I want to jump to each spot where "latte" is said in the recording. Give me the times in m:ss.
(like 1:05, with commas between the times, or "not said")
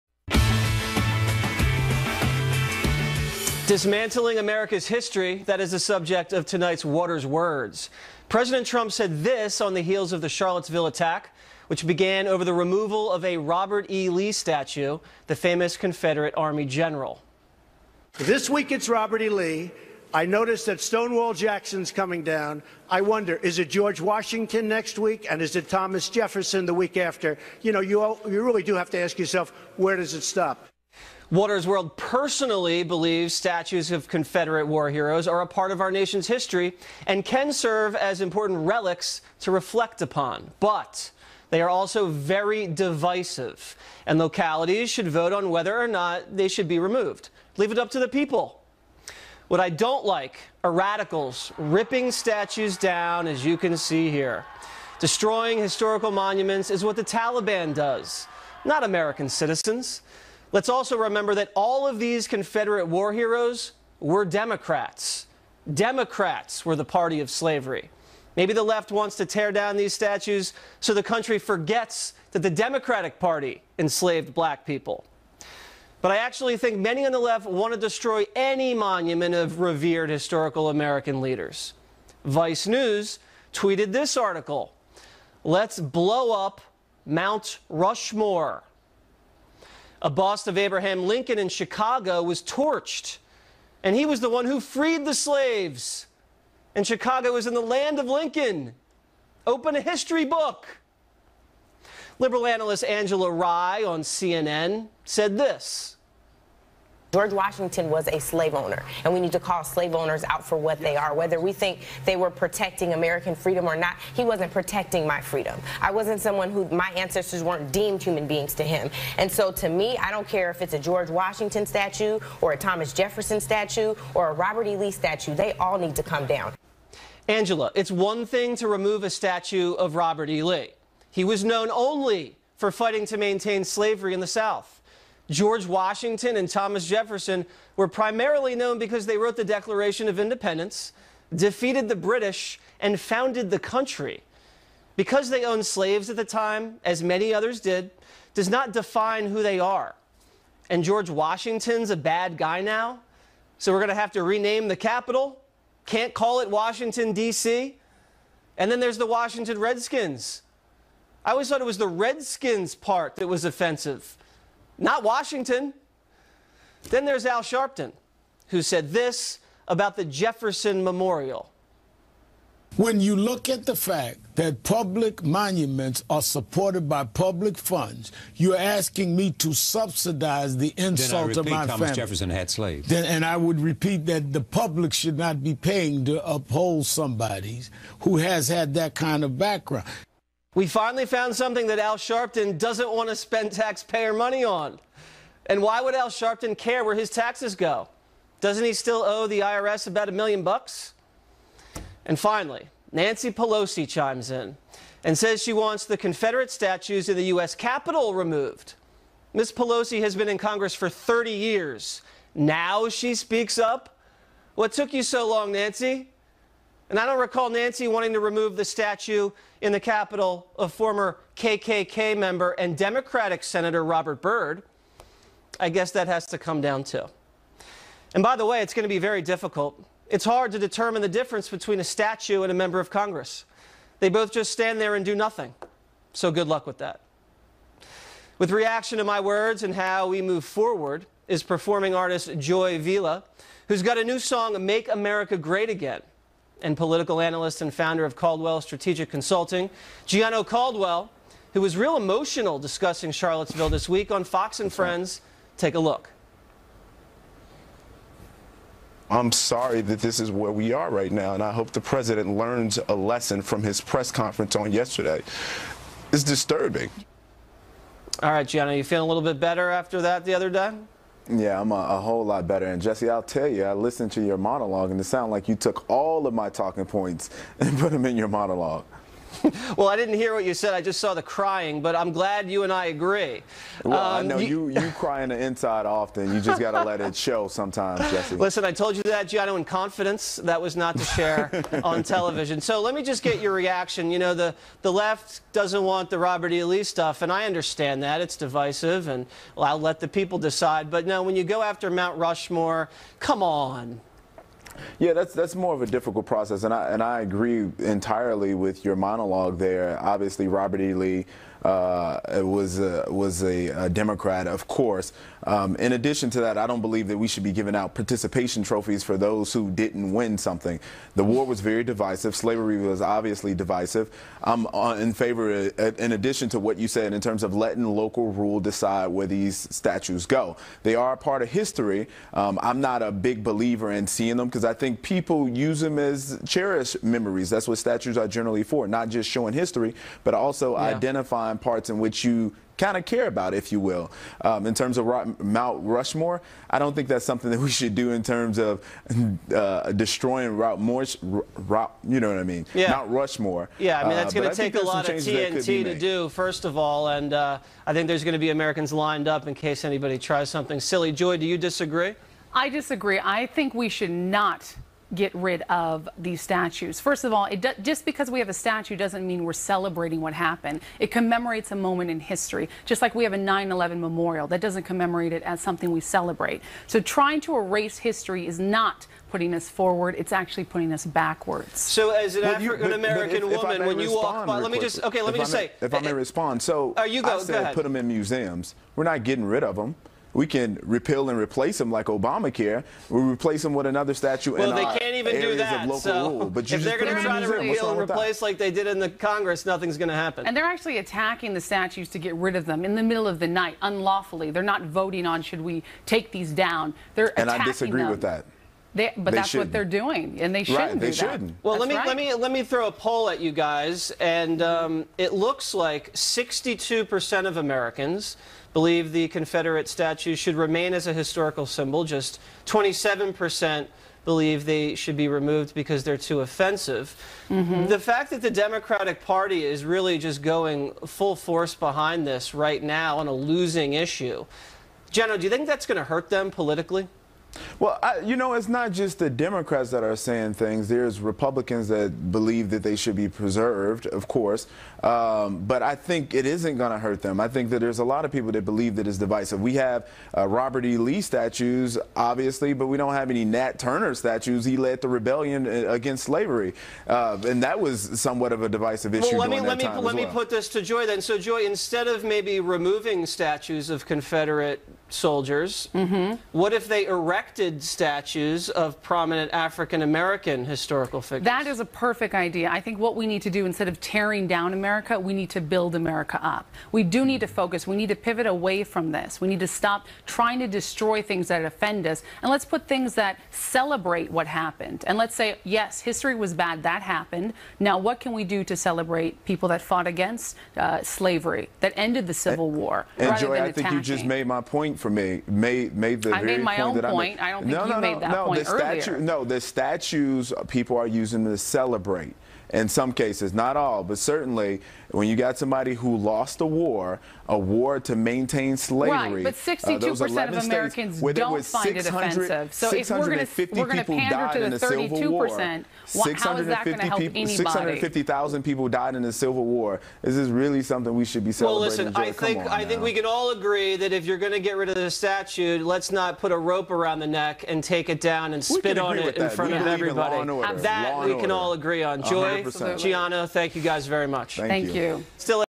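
not said.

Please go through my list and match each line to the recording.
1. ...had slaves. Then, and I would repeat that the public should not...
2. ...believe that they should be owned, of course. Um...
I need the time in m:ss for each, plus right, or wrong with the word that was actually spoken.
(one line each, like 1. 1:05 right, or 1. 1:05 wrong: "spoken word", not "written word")
1. 3:02 right
2. 7:22 wrong: "preserved", not "owned".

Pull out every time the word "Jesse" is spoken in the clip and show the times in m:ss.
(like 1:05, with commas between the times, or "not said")
4:32, 4:48.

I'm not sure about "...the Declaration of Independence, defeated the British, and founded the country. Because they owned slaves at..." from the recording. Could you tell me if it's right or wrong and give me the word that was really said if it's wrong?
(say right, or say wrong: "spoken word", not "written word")
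right.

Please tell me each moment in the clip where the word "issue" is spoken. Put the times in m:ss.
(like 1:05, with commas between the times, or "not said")
7:13, 7:39.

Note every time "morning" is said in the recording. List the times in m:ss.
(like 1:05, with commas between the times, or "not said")
not said.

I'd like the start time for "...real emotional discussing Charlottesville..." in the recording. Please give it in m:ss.
4:11.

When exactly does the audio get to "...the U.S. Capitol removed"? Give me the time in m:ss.
3:27.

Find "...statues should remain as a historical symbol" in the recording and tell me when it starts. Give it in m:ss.
6:59.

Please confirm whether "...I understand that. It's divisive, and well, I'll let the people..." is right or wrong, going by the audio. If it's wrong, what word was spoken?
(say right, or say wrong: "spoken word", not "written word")
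right.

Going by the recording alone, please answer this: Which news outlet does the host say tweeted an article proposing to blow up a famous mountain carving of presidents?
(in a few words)
Vice News.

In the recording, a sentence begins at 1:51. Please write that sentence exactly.
Whether we think they were protecting American freedom or not, he wasn't protecting my freedom.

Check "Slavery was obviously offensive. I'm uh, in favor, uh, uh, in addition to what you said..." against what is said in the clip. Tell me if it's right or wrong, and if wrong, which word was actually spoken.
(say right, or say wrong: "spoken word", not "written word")
wrong: "divisive", not "offensive".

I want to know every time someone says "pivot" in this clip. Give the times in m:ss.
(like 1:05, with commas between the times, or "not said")
7:58.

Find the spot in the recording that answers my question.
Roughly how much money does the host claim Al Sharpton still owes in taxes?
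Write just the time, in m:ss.
3:19.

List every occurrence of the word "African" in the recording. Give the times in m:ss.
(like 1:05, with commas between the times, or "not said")
6:22, 7:49.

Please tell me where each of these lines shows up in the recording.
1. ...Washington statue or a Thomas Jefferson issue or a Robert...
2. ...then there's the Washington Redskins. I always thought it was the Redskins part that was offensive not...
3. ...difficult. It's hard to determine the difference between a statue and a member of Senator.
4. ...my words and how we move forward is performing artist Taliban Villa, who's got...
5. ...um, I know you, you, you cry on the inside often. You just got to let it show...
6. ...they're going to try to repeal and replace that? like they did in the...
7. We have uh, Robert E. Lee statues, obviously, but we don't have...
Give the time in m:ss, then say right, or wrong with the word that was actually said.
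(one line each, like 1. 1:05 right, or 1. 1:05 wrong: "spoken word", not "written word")
1. 2:01 wrong: "statue", not "issue"
2. 2:38 right
3. 3:49 wrong: "Congress", not "Senator"
4. 3:59 wrong: "Joy", not "Taliban"
5. 4:43 right
6. 6:36 right
7. 7:29 right.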